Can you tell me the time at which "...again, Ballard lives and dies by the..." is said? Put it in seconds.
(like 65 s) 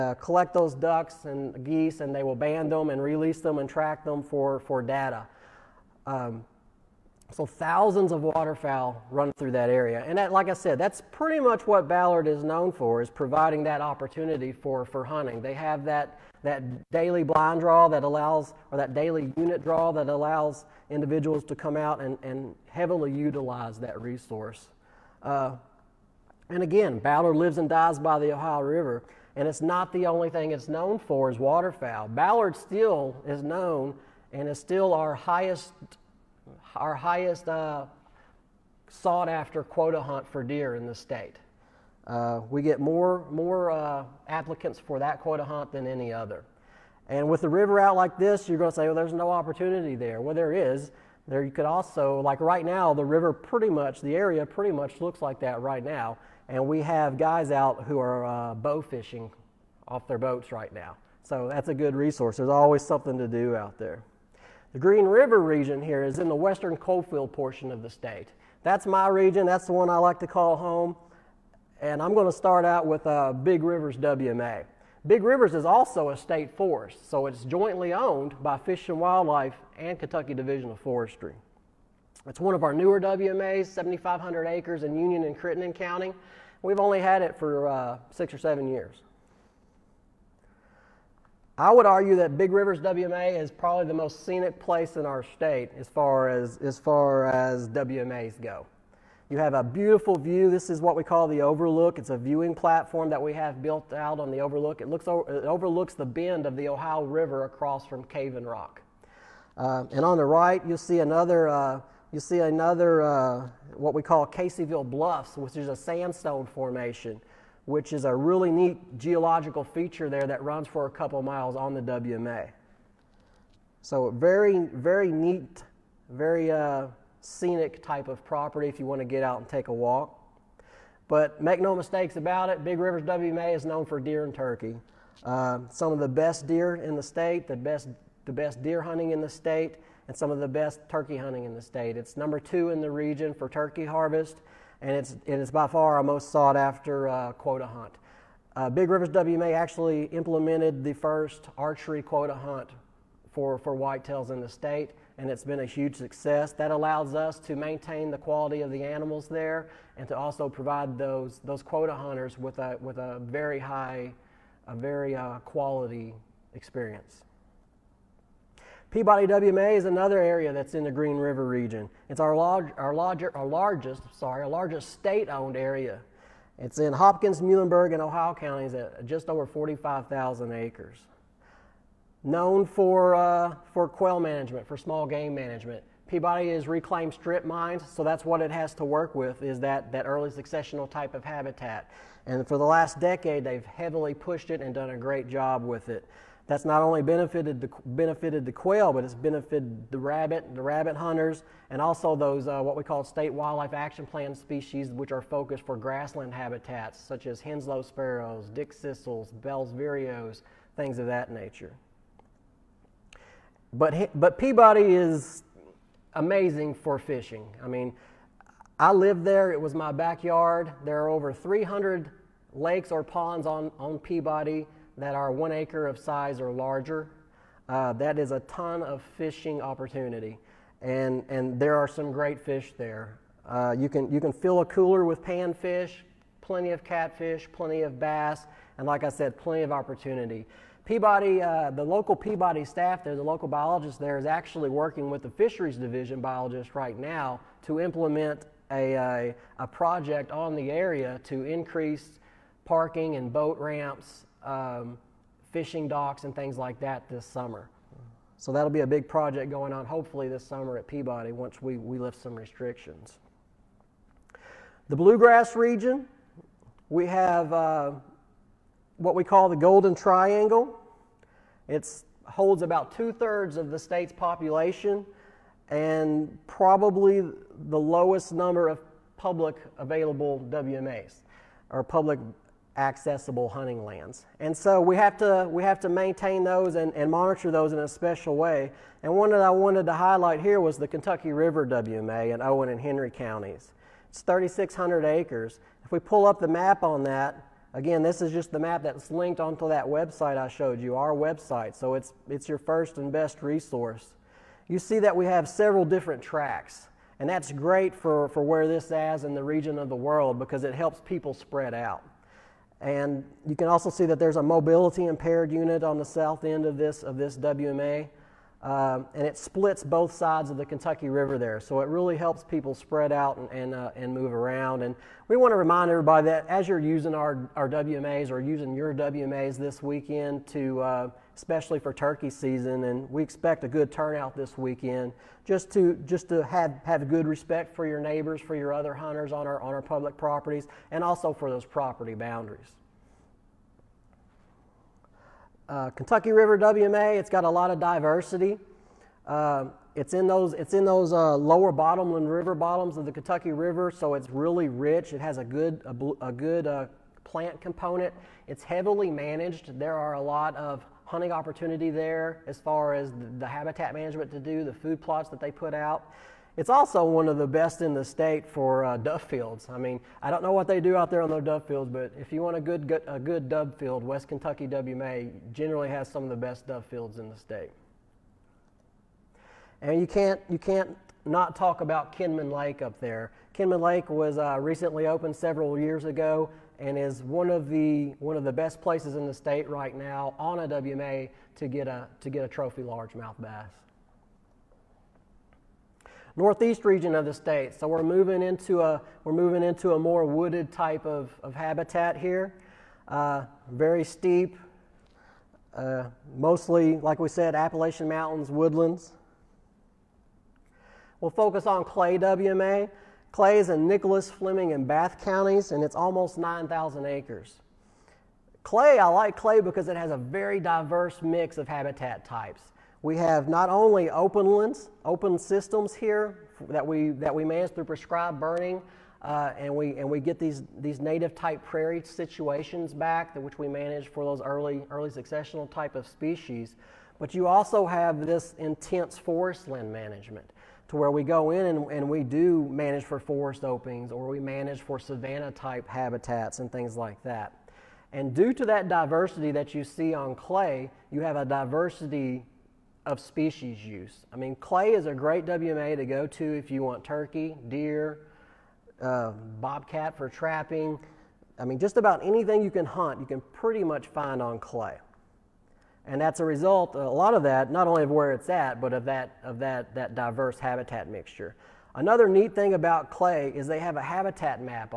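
26 s.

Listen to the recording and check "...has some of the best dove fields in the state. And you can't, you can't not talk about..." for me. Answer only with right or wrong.
right.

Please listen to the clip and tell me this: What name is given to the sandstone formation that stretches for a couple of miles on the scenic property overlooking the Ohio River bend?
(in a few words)
Caseyville Bluffs.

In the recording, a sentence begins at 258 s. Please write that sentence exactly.
So that'll be a big project going on hopefully this summer at Peabody once we, we lift some restrictions.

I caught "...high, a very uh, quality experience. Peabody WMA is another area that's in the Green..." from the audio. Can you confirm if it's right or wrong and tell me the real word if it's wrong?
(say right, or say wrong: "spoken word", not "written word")
right.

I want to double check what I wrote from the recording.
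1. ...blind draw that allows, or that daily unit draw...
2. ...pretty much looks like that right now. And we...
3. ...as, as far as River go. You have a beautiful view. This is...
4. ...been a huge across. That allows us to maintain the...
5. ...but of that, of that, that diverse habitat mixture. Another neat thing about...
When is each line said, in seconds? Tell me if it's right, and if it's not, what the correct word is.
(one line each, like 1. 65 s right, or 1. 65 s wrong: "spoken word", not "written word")
1. 17 s right
2. 54 s right
3. 96 s wrong: "WMAs", not "River"
4. 155 s wrong: "success", not "across"
5. 468 s right.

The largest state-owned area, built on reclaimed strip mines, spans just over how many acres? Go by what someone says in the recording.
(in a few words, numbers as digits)
45,000 acres.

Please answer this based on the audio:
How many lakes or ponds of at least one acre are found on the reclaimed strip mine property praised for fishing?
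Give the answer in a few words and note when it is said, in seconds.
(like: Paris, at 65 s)
Over 300, at 221 s.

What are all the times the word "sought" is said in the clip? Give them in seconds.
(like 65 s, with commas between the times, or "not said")
38 s, 146 s.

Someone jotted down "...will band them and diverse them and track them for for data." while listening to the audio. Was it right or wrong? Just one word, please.
wrong.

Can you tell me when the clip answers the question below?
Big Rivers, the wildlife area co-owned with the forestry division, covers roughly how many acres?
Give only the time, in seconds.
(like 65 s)
83 s.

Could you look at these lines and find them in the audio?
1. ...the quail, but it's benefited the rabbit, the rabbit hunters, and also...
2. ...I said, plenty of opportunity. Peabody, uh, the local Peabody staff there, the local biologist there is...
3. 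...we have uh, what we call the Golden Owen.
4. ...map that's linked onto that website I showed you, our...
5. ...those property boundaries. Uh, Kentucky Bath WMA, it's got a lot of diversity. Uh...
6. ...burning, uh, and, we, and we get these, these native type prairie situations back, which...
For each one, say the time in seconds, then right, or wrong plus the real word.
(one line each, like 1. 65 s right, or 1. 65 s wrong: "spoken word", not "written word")
1. 198 s right
2. 239 s right
3. 266 s wrong: "Triangle", not "Owen"
4. 298 s right
5. 341 s wrong: "River", not "Bath"
6. 428 s right.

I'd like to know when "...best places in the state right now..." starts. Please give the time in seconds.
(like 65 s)
388 s.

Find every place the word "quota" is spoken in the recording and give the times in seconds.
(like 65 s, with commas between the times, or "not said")
39 s, 45 s, 147 s, 152 s, 161 s.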